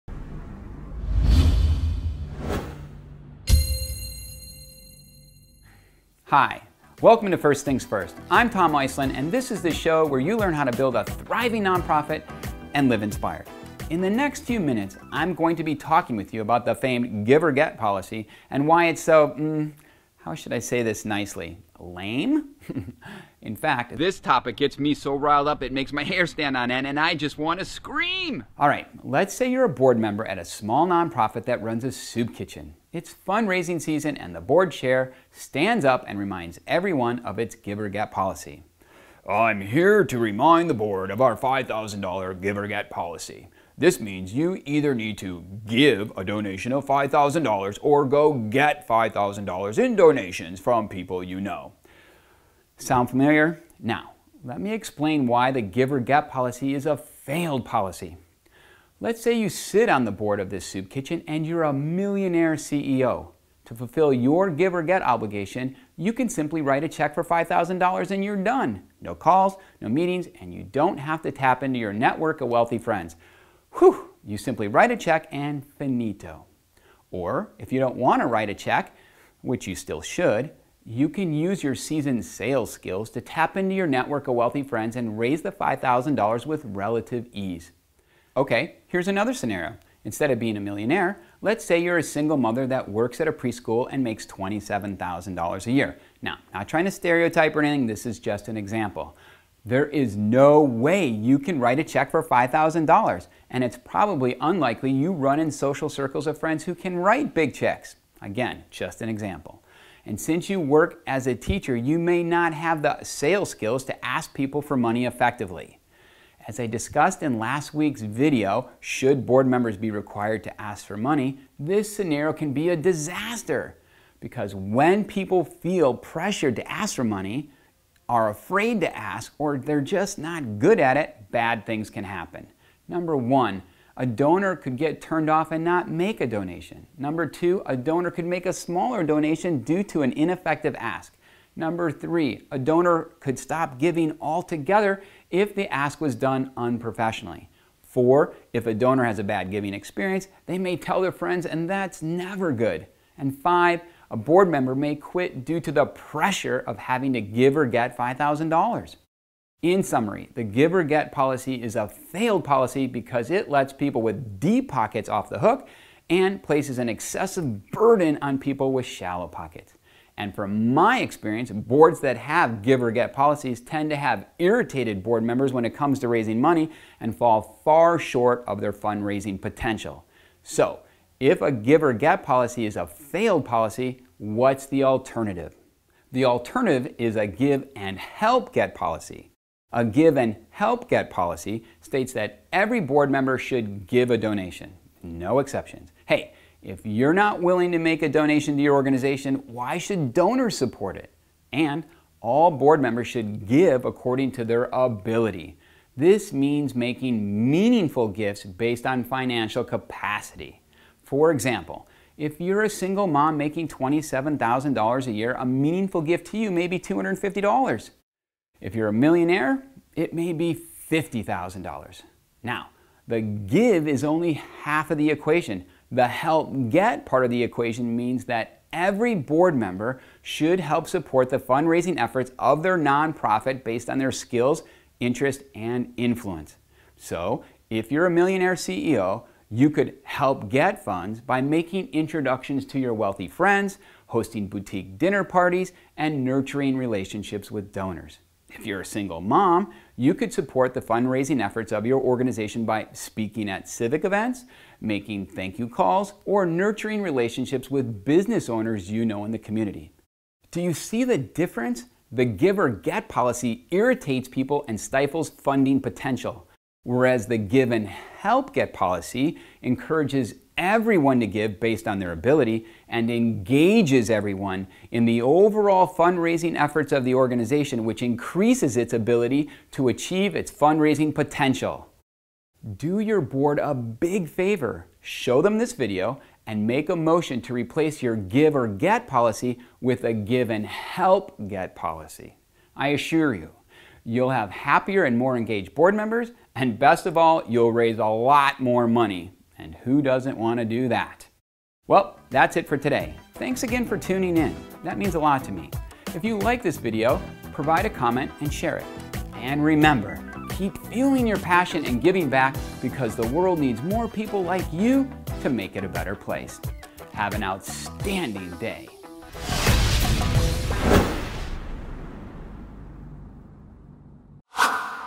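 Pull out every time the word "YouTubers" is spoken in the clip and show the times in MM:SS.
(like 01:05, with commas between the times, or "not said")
not said.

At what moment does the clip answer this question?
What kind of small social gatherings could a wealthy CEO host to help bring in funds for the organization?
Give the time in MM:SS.
04:04.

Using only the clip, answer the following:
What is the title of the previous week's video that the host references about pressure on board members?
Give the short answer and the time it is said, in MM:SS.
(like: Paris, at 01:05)
Should board members be required to ask for money, at 01:58.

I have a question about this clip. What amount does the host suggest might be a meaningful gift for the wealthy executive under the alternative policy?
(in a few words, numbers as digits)
$50,000.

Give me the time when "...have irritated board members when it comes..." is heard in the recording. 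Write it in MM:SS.
02:53.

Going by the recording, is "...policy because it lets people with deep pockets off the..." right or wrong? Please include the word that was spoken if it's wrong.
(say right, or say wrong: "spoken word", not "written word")
right.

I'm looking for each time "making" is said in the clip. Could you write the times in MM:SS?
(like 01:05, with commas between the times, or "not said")
03:26, 03:33, 04:01, 04:14.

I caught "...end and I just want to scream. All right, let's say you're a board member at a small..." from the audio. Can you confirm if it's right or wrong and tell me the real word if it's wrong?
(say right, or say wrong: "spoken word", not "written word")
right.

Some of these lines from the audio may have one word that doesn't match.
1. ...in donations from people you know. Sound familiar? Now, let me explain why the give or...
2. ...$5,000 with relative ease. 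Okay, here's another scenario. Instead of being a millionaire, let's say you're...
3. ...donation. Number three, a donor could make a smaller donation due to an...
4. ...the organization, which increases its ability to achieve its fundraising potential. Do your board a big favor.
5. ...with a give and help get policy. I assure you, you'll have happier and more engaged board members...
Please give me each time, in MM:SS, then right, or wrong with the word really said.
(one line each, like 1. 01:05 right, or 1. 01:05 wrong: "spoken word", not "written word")
1. 00:49 right
2. 01:25 right
3. 02:16 wrong: "two", not "three"
4. 04:37 right
5. 04:49 right.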